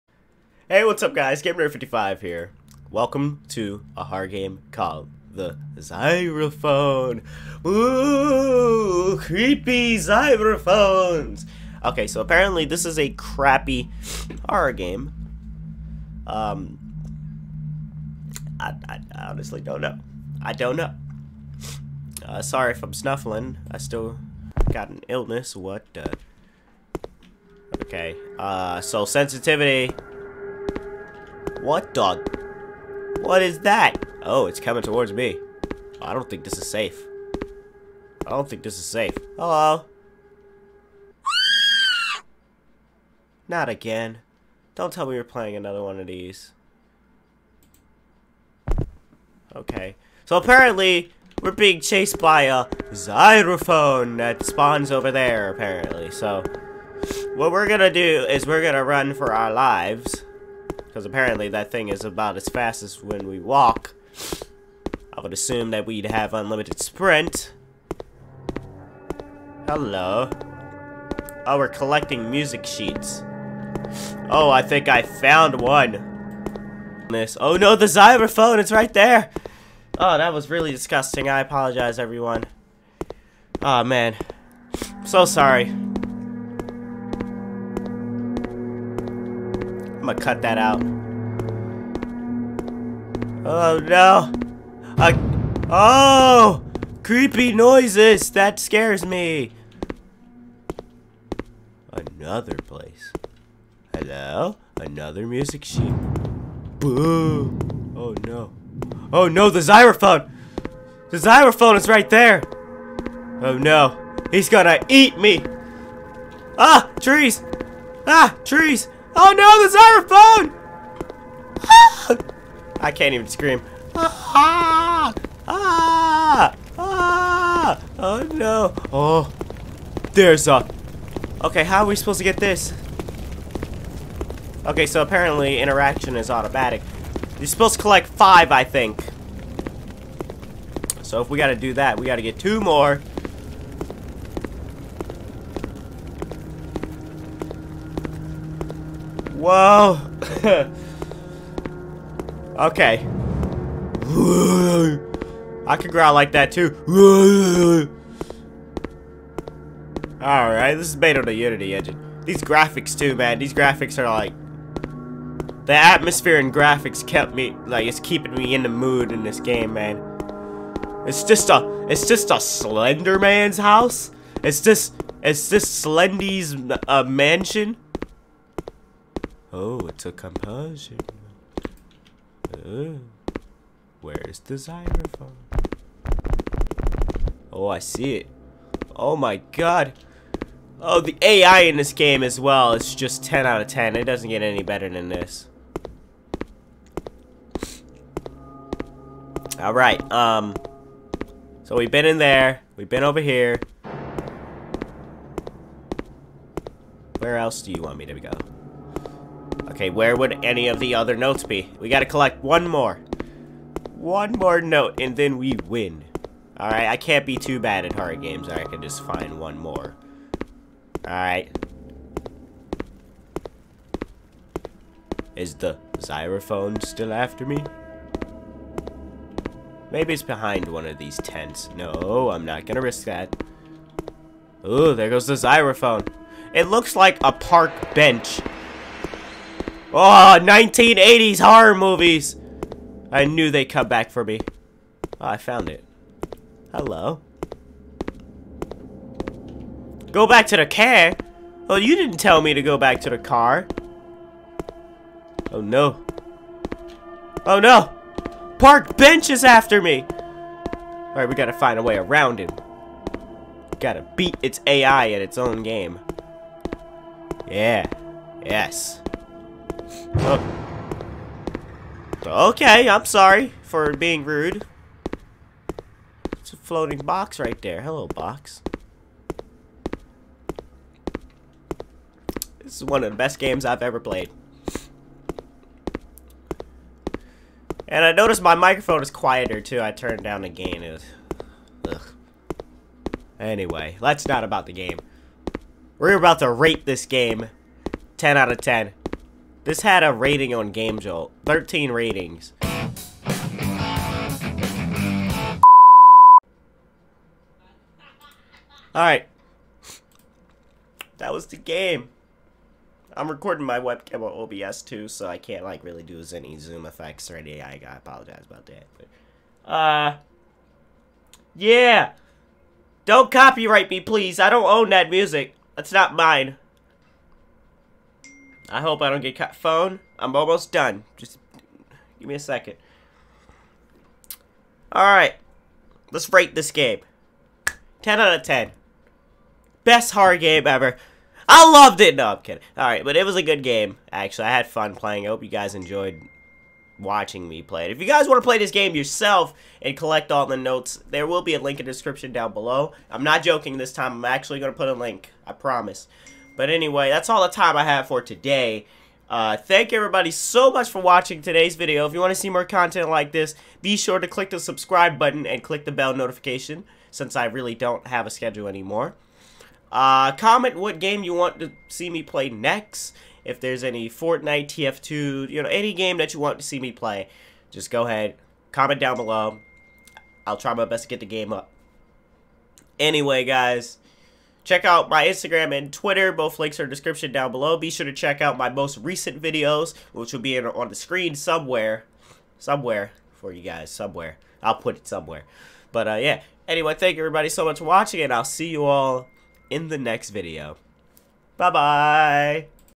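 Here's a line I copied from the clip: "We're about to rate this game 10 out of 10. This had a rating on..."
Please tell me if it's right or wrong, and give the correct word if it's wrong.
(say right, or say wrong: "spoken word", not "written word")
right.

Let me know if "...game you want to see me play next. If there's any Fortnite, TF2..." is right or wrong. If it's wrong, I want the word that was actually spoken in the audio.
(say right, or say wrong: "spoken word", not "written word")
right.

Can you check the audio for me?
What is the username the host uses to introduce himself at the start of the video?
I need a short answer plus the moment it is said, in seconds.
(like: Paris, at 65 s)
GamerNerd55, at 1 s.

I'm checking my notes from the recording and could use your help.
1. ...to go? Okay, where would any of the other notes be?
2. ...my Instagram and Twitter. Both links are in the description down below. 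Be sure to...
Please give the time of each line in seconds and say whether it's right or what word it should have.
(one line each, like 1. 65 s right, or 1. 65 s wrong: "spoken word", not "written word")
1. 208 s right
2. 385 s right.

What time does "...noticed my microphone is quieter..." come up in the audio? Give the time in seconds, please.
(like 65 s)
288 s.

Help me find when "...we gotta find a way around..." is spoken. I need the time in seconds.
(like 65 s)
261 s.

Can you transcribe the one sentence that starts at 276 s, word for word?
It's a floating box right there.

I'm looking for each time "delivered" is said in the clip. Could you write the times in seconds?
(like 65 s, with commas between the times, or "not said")
not said.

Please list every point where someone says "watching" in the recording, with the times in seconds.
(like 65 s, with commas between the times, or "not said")
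346 s, 361 s, 397 s.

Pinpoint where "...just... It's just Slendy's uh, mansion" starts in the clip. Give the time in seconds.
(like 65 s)
174 s.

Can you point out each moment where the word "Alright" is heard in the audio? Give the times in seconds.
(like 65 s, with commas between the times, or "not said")
160 s, 199 s, 216 s, 221 s, 308 s, 334 s, 342 s.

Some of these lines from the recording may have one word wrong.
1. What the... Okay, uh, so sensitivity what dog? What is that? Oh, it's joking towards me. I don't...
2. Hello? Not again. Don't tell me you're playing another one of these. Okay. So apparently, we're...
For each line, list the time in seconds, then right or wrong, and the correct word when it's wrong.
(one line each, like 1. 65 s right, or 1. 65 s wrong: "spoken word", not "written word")
1. 25 s wrong: "coming", not "joking"
2. 39 s right.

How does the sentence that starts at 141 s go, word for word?
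So if we gotta do that, we gotta get two more.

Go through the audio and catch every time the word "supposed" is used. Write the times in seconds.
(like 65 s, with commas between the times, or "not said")
131 s, 137 s.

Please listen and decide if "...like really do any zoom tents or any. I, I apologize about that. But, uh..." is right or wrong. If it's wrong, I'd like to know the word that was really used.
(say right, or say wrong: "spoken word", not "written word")
wrong: "effects", not "tents".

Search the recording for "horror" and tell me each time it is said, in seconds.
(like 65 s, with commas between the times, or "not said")
14 s, 217 s, 241 s, 340 s.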